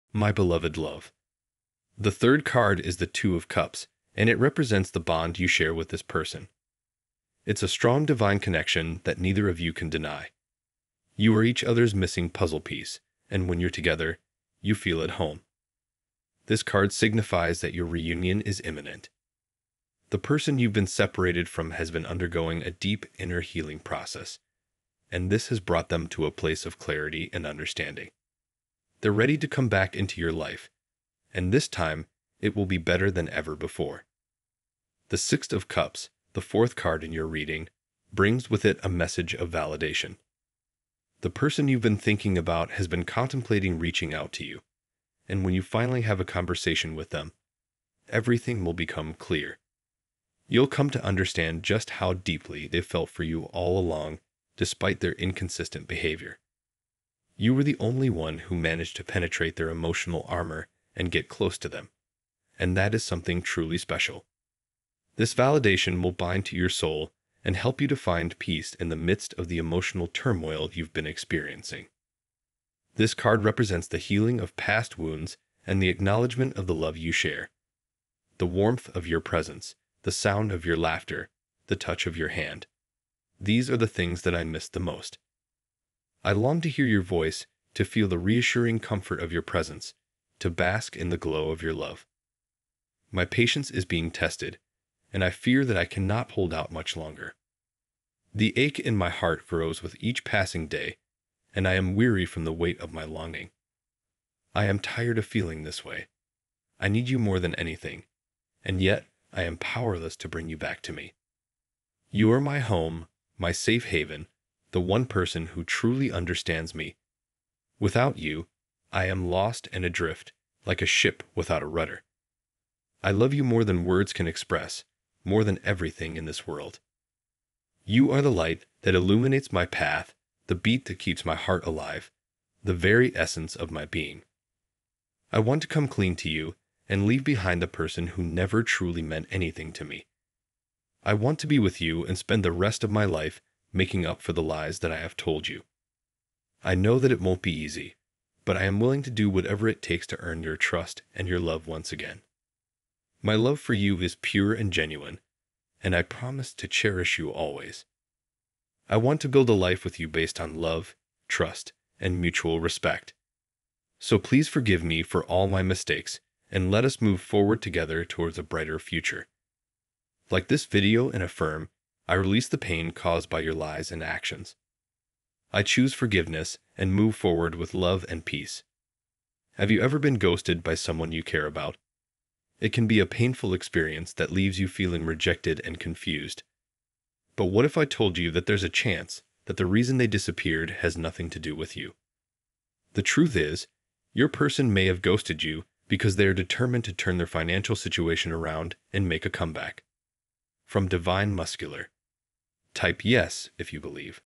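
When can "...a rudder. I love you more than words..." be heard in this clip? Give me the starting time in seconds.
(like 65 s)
121 s.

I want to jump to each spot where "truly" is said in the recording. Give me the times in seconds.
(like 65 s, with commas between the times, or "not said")
63 s, 115 s, 138 s.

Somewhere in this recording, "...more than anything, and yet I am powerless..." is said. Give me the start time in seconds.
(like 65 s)
107 s.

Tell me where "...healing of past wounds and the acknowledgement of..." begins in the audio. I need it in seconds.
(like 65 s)
73 s.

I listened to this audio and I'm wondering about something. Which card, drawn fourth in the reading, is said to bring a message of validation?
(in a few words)
Six of Cups.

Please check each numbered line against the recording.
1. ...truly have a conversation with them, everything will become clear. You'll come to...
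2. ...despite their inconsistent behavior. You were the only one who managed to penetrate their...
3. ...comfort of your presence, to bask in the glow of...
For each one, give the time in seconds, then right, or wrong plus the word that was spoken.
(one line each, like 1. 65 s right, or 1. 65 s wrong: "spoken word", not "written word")
1. 45 s wrong: "finally", not "truly"
2. 54 s right
3. 88 s right.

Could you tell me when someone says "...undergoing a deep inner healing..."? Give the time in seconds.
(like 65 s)
22 s.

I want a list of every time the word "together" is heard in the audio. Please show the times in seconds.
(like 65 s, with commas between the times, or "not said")
13 s, 167 s.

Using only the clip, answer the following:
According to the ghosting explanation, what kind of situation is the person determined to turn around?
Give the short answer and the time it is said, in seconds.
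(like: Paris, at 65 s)
Financial, at 197 s.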